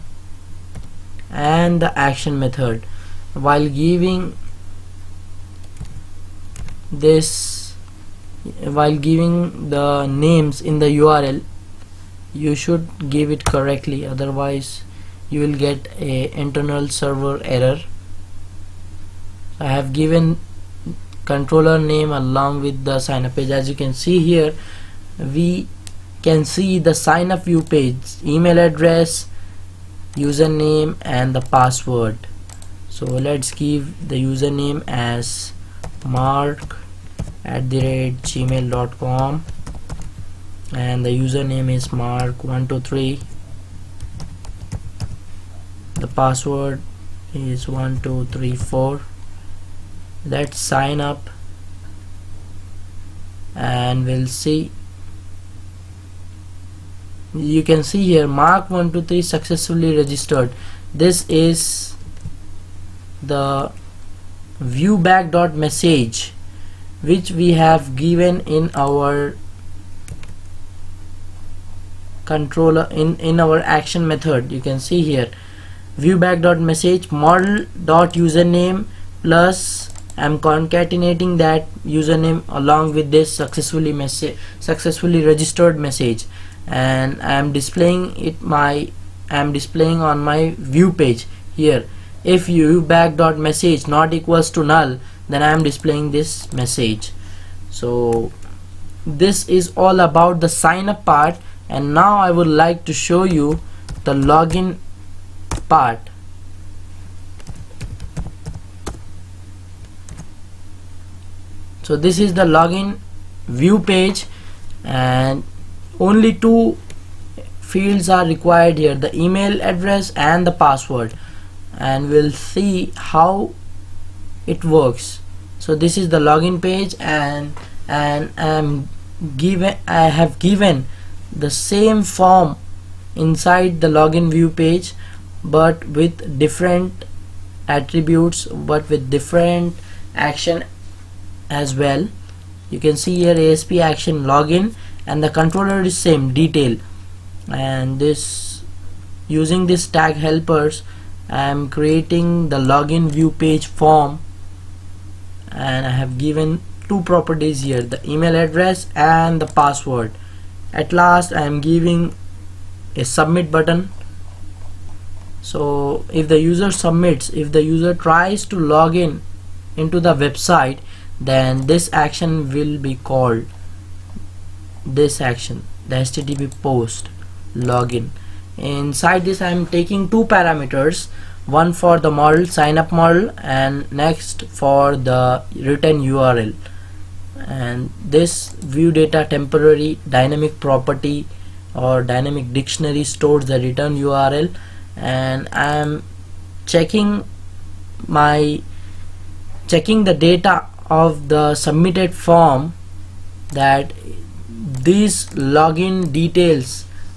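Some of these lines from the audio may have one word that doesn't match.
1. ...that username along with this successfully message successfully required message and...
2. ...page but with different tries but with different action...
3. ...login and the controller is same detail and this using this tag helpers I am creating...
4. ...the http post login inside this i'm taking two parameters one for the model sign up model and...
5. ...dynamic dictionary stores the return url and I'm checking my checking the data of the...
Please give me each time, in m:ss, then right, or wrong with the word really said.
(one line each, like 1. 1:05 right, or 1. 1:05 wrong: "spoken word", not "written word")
1. 1:21 wrong: "registered", not "required"
2. 2:14 wrong: "attributes", not "tries"
3. 2:24 right
4. 2:55 right
5. 3:12 right.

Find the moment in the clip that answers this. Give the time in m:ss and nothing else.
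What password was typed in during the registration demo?
0:47.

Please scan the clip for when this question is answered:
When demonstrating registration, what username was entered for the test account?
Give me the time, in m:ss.
0:41.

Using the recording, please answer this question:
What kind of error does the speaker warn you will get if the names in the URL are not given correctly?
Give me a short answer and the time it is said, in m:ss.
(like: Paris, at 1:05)
internal server error, at 0:16.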